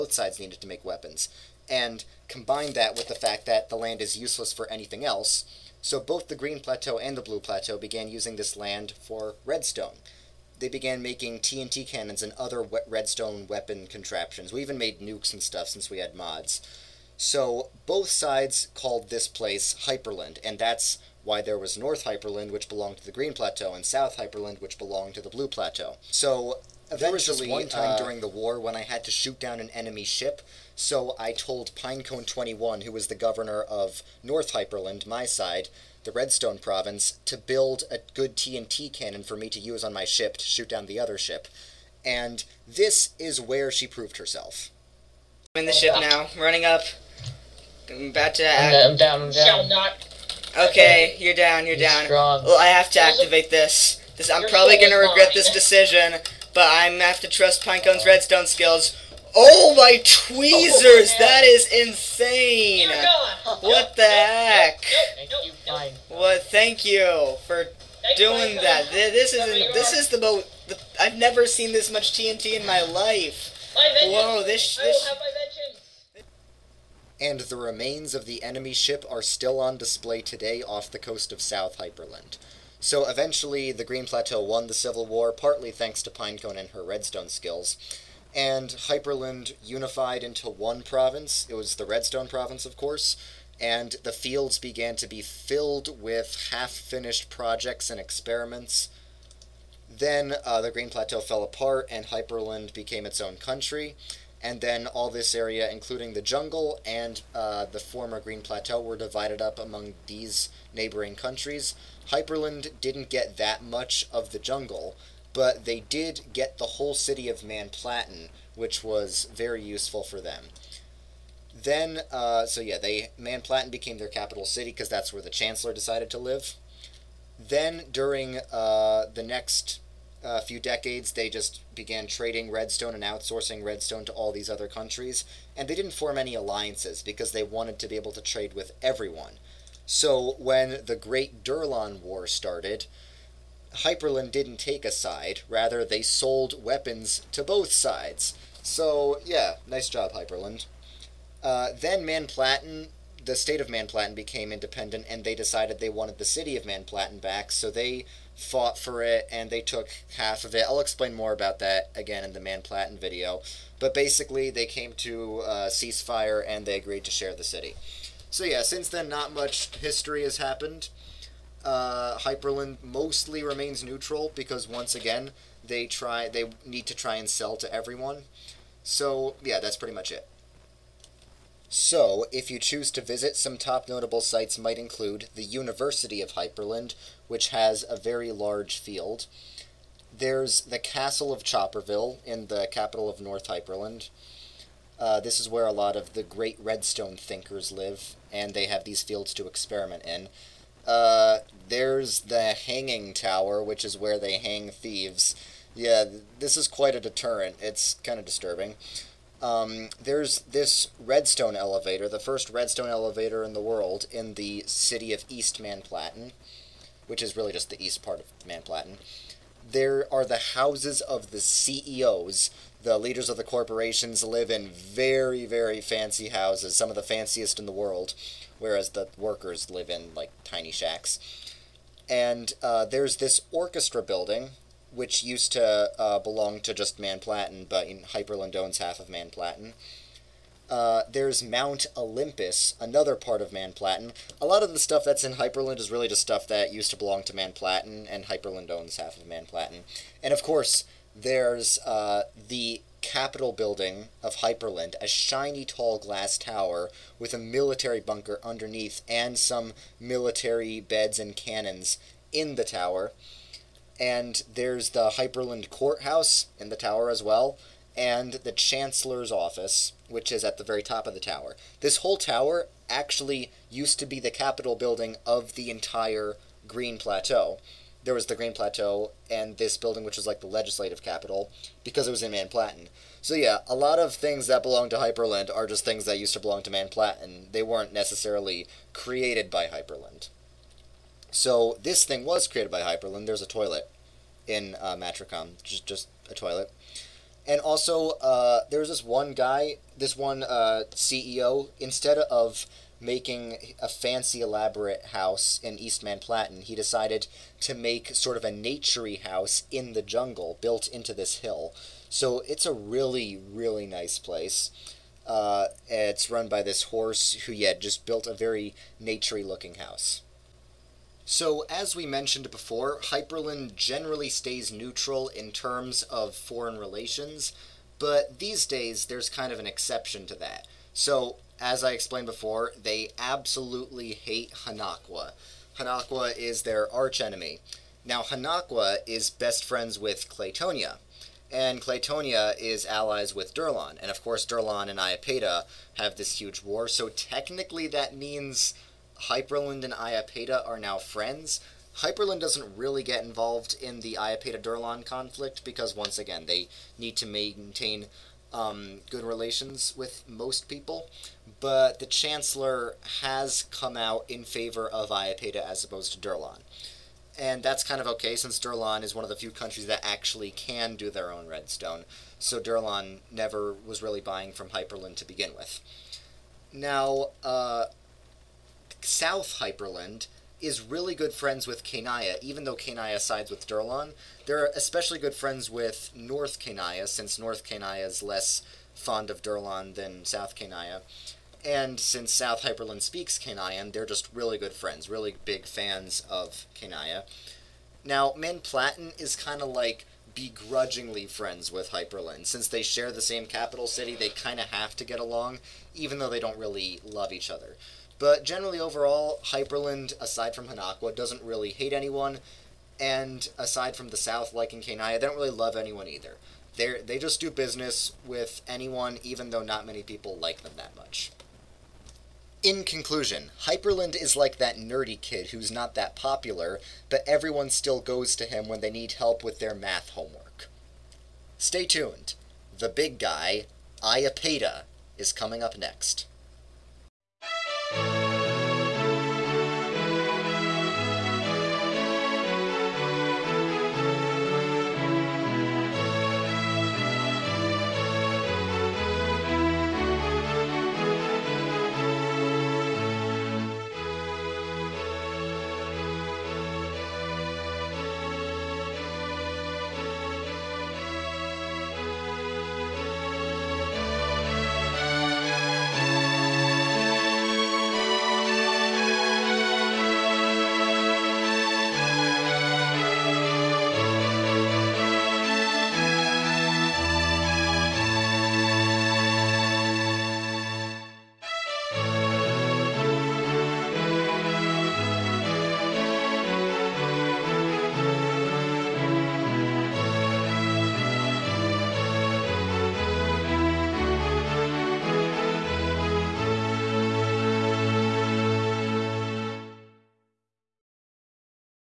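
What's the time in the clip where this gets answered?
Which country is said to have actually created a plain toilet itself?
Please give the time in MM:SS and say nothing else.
04:54.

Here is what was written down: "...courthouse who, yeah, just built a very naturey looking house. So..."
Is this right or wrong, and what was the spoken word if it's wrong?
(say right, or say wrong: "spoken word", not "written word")
wrong: "horse", not "courthouse".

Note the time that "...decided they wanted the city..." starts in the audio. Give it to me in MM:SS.
02:35.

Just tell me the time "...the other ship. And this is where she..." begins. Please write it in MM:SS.
00:40.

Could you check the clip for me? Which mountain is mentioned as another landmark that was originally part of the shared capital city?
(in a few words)
Mount Olympus.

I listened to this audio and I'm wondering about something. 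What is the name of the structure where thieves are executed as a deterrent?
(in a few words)
hanging tower.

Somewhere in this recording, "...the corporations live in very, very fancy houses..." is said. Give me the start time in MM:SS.
03:43.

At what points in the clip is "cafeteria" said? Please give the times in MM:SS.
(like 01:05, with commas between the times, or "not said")
not said.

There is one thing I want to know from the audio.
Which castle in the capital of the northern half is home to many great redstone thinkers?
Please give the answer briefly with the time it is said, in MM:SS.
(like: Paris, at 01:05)
Castle of Chopperville, at 03:10.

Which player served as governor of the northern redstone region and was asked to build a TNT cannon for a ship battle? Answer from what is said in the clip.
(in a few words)
Pinecone 21.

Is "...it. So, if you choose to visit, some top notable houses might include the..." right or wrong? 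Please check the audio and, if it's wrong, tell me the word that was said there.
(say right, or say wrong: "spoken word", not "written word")
wrong: "sites", not "houses".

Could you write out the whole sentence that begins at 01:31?
It was the Redstone province, of course, and the fields began to be filled with half finished projects and experiments.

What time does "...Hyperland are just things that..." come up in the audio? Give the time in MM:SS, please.
04:44.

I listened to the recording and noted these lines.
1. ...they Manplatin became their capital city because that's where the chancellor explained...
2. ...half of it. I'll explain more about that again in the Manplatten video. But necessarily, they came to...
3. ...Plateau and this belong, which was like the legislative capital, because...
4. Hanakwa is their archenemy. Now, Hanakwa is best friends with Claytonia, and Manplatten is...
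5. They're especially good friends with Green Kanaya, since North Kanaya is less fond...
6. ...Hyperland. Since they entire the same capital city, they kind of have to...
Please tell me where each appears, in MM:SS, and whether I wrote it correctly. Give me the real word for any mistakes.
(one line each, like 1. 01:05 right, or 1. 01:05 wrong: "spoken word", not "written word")
1. 02:02 wrong: "decided", not "explained"
2. 02:40 wrong: "basically", not "necessarily"
3. 04:38 wrong: "building", not "belong"
4. 05:35 wrong: "Claytonia", not "Manplatten"
5. 06:24 wrong: "North", not "Green"
6. 06:41 wrong: "share", not "entire".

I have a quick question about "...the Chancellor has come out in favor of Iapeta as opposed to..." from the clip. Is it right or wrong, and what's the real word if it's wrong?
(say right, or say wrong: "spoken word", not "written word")
right.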